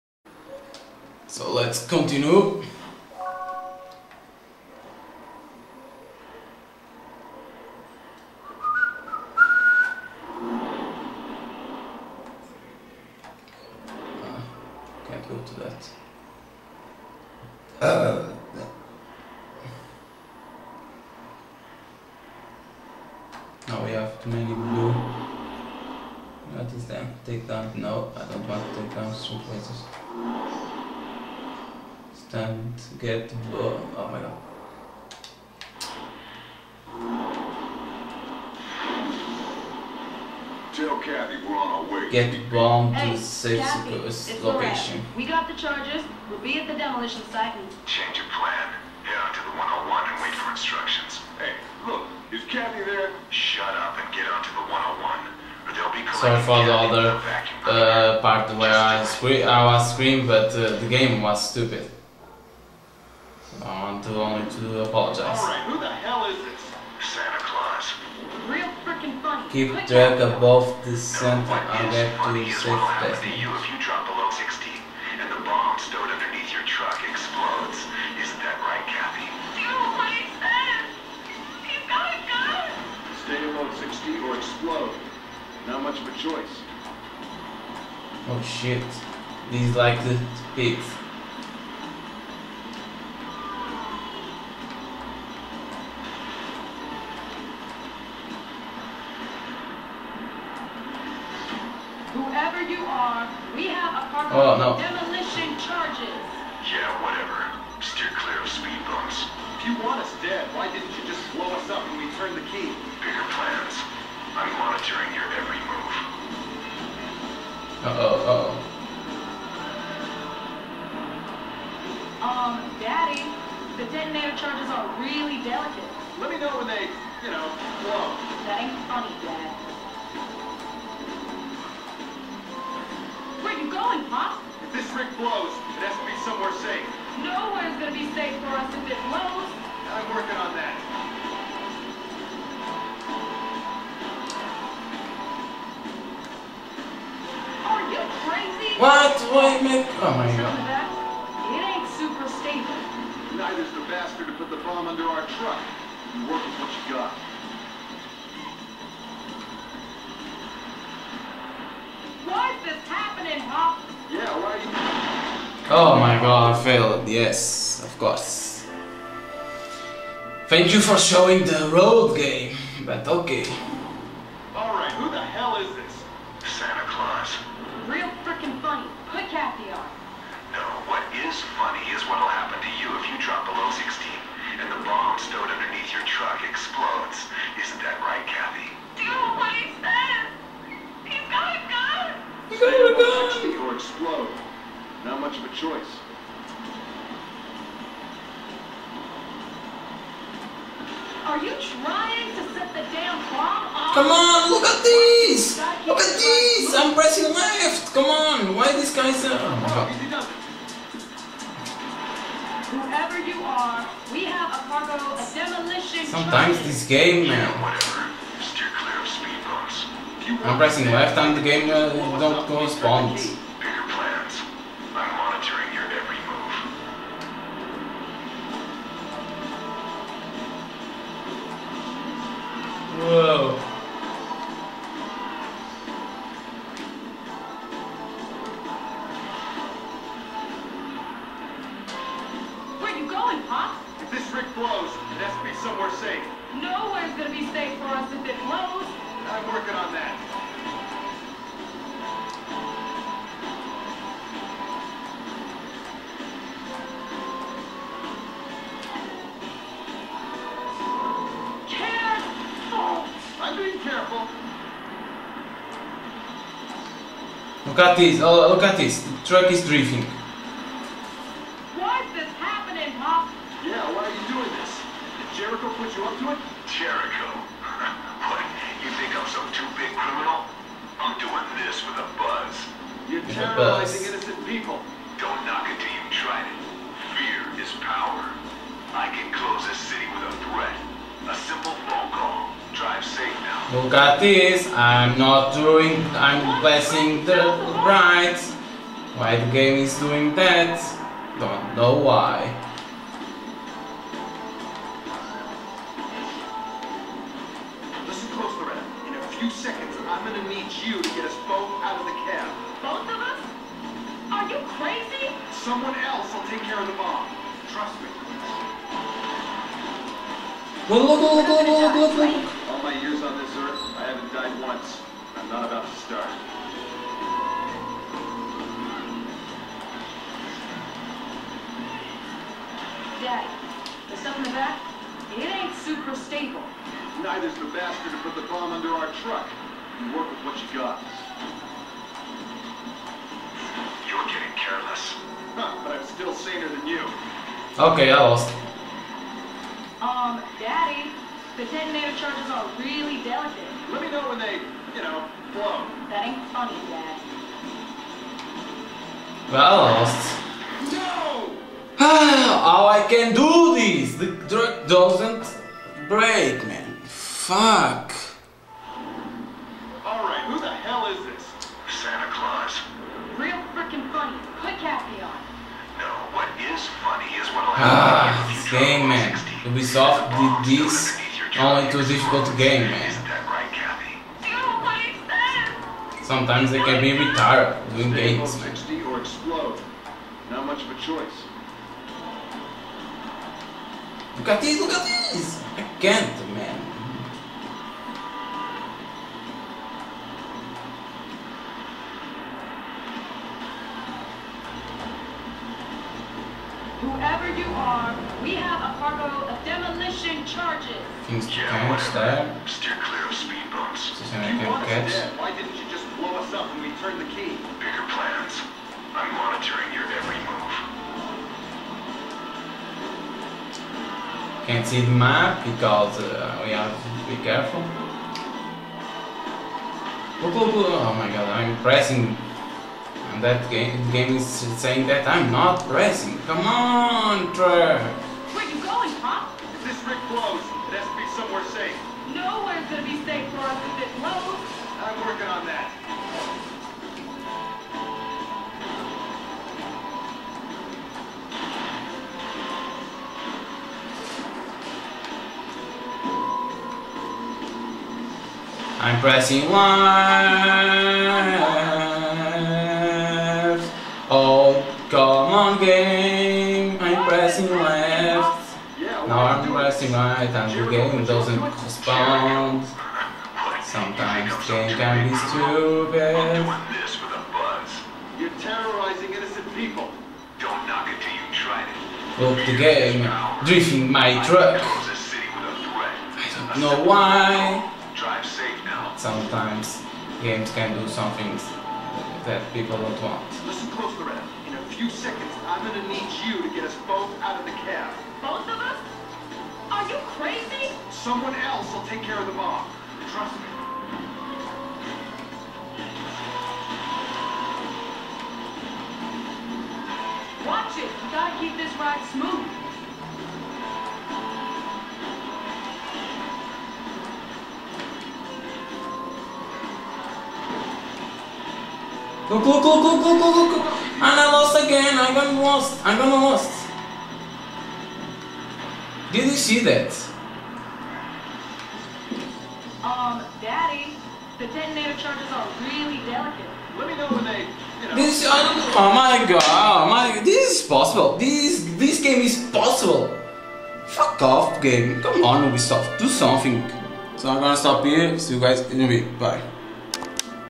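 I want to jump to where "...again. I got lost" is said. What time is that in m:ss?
8:44.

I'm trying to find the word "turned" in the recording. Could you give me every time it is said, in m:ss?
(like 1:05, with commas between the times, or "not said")
1:52, 6:56.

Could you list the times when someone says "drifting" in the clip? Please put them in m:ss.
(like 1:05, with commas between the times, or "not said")
4:29, 8:03.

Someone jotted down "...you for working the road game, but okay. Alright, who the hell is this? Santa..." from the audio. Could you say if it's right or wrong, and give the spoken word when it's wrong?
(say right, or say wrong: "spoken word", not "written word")
wrong: "showing", not "working".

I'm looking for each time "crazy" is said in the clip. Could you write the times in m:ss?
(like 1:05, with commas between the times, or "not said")
2:28, 5:14, 8:20.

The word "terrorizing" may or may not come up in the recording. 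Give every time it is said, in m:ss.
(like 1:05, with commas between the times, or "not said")
4:43, 7:58.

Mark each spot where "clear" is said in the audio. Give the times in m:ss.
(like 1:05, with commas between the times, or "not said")
1:48, 6:53.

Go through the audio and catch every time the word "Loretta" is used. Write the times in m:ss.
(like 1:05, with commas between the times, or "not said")
8:14.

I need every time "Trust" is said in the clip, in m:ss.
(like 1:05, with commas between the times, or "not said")
5:17, 8:23.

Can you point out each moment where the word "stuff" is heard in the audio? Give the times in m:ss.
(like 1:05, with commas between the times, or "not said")
5:34.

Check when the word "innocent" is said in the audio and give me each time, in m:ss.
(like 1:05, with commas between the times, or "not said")
4:44, 7:59.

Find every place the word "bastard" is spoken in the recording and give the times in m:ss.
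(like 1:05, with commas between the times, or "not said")
2:33, 5:37.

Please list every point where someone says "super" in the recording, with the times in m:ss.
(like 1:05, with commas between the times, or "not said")
2:31, 5:35.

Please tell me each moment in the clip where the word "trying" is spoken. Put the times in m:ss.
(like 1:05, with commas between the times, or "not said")
3:21.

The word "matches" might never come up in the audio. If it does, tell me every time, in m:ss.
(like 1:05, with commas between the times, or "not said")
not said.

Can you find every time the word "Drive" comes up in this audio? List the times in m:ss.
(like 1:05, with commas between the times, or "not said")
4:52.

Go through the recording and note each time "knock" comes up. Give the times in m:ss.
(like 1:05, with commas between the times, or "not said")
4:45, 8:00.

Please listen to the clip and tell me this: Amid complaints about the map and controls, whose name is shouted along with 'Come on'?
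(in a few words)
Trevor.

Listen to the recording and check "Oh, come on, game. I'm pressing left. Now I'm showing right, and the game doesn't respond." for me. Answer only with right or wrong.
wrong.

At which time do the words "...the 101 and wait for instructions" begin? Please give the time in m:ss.
0:49.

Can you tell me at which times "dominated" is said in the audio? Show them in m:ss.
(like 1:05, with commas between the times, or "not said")
not said.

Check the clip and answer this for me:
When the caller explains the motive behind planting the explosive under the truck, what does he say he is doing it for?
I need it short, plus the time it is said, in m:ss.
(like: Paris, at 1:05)
the buzz, at 4:41.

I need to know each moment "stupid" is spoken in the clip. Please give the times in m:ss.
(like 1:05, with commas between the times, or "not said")
1:01, 7:55.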